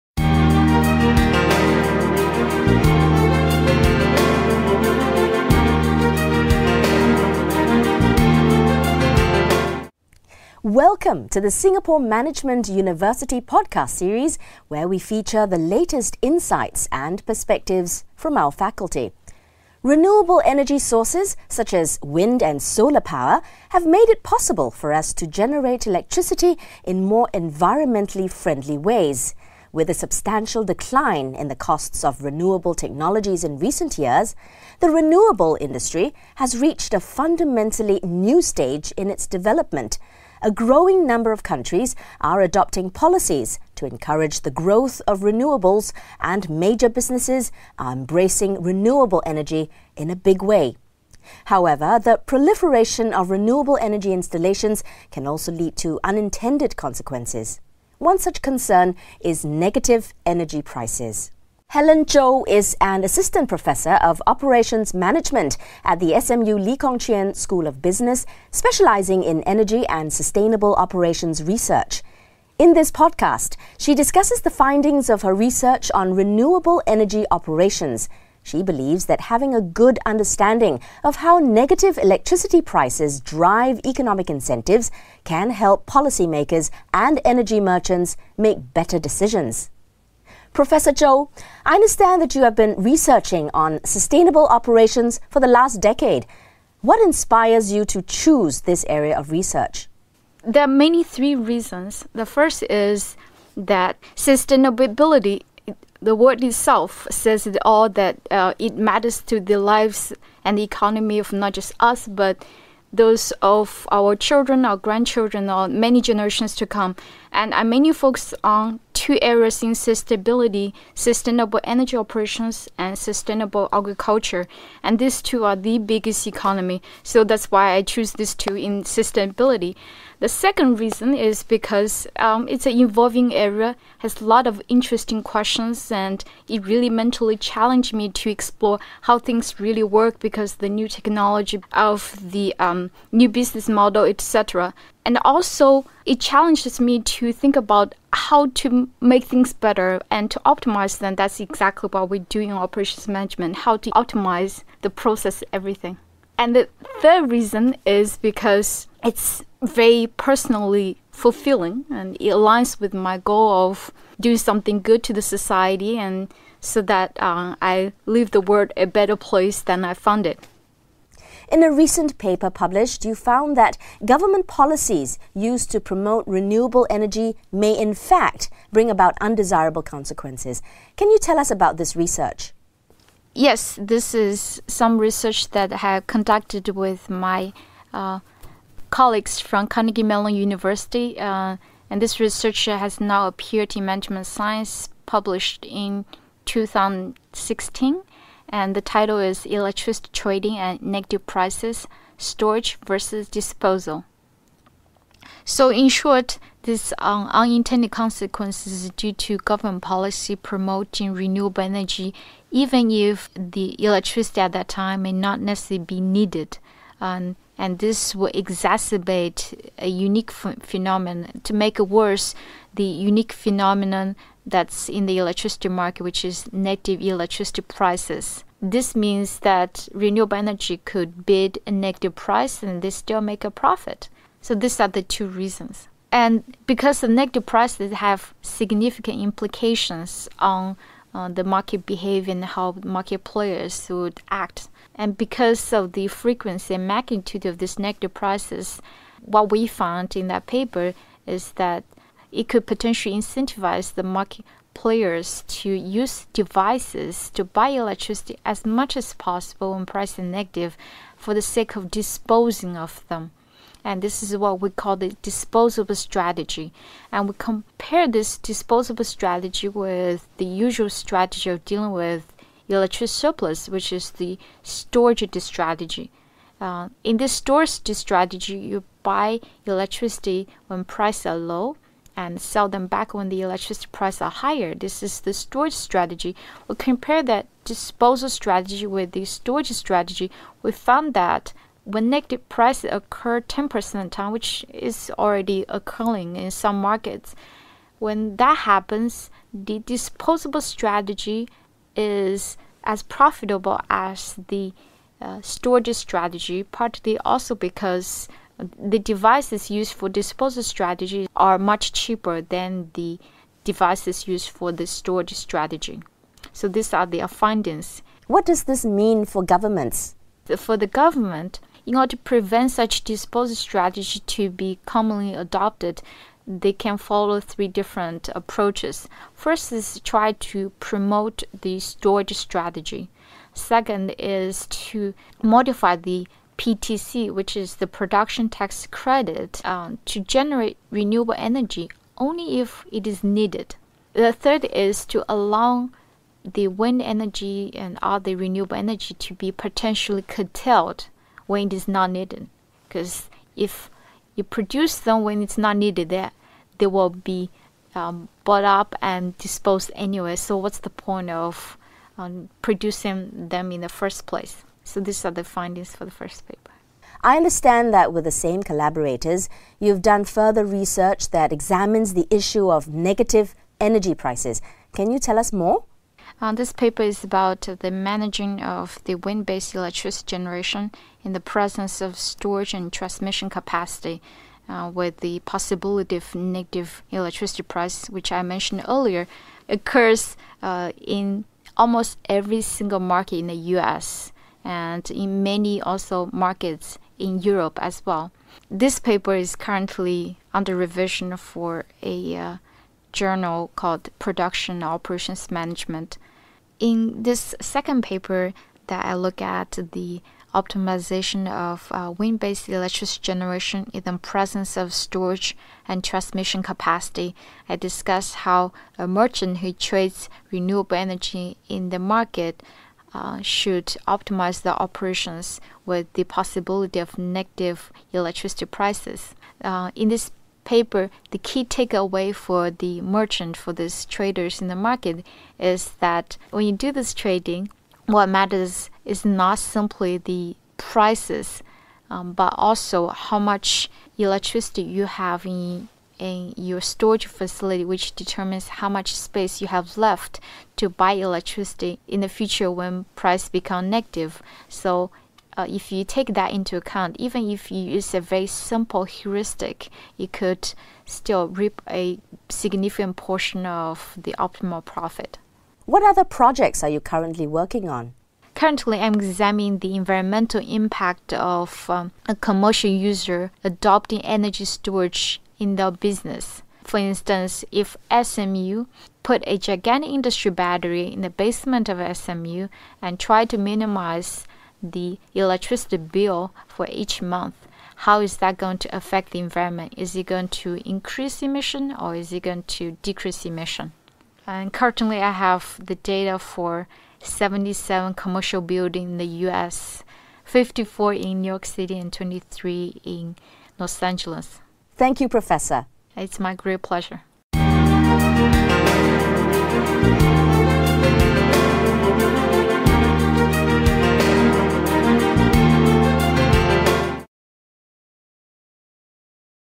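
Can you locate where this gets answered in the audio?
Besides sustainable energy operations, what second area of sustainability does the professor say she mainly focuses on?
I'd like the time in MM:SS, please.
02:02.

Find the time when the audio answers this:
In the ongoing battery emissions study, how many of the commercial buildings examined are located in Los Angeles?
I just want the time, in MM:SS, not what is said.
08:22.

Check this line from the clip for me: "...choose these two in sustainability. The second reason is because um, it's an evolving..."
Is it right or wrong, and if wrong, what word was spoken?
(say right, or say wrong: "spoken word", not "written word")
right.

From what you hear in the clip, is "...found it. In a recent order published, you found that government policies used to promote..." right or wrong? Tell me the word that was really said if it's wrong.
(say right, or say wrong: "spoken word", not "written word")
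wrong: "paper", not "order".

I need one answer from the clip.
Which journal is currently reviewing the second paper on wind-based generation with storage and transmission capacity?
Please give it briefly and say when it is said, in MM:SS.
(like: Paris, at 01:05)
Production Operations Management, at 06:44.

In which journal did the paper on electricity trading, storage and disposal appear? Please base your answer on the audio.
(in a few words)
Management Science.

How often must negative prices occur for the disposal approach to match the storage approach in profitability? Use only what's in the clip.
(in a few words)
10% of the time.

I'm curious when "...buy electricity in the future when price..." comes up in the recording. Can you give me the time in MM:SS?
07:30.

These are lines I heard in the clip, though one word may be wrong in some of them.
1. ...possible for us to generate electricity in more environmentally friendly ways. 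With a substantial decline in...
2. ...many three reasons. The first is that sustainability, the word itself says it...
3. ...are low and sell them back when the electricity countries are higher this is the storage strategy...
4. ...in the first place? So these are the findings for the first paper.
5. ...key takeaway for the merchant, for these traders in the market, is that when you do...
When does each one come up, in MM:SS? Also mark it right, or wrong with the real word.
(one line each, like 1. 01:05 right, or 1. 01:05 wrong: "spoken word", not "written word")
1. 00:24 right
2. 01:40 right
3. 04:41 wrong: "prices", not "countries"
4. 06:03 right
5. 07:11 right.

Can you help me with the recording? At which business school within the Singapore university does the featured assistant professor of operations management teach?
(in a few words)
Lee Kong-Chian School of Business.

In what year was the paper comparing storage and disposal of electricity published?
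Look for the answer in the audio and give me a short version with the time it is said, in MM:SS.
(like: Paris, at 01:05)
2016, at 03:16.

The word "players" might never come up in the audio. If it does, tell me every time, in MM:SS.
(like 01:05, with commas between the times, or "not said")
04:03, 04:14.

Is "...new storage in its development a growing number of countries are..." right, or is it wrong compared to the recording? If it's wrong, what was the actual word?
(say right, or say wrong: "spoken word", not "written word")
wrong: "stage", not "storage".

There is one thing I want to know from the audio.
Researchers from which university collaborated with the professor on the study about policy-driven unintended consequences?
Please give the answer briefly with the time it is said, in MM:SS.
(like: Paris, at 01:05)
Carnegie Mellon University, at 03:09.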